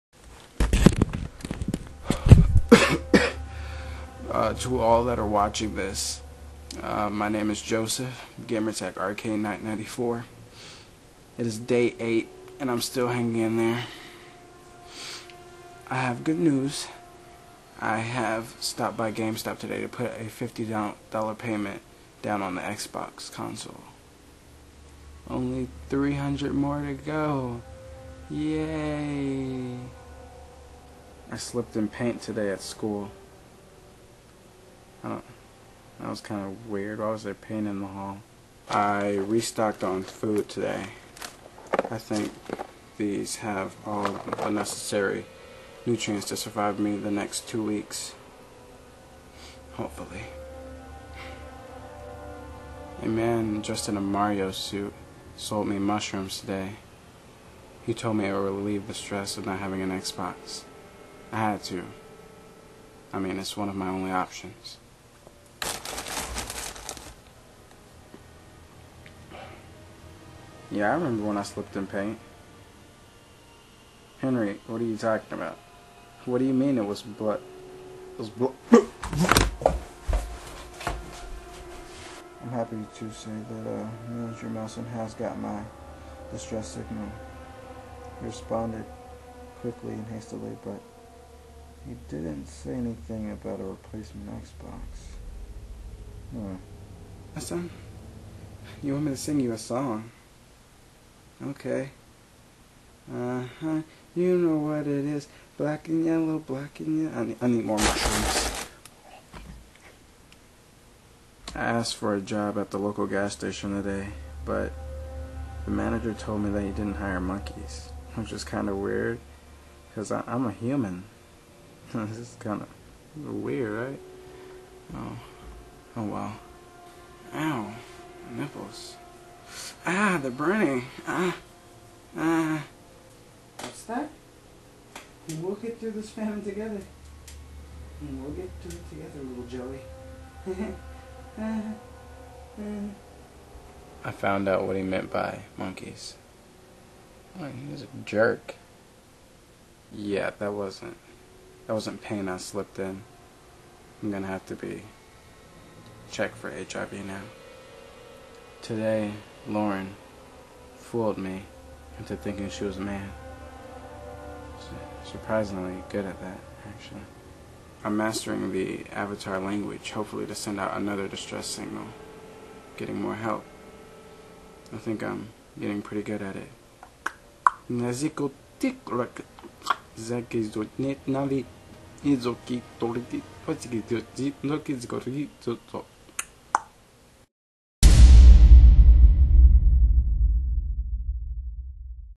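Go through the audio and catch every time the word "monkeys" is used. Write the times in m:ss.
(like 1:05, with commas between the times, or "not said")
1:57, 2:25.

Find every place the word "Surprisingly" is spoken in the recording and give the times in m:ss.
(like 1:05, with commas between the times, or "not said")
2:45.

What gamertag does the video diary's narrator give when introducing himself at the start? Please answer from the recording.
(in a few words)
Arcade 994.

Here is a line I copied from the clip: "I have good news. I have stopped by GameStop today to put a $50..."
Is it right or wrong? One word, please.
right.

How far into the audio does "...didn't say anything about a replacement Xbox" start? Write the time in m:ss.
1:32.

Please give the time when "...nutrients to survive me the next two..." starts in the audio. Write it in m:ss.
0:45.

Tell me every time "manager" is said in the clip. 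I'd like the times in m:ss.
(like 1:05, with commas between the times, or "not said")
1:24, 1:55.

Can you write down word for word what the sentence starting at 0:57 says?
He told me it would relieve the stress of not having an Xbox.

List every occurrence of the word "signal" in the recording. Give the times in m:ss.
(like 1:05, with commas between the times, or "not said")
1:26, 2:51.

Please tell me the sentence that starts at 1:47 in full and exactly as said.
I need, I need more mushrooms.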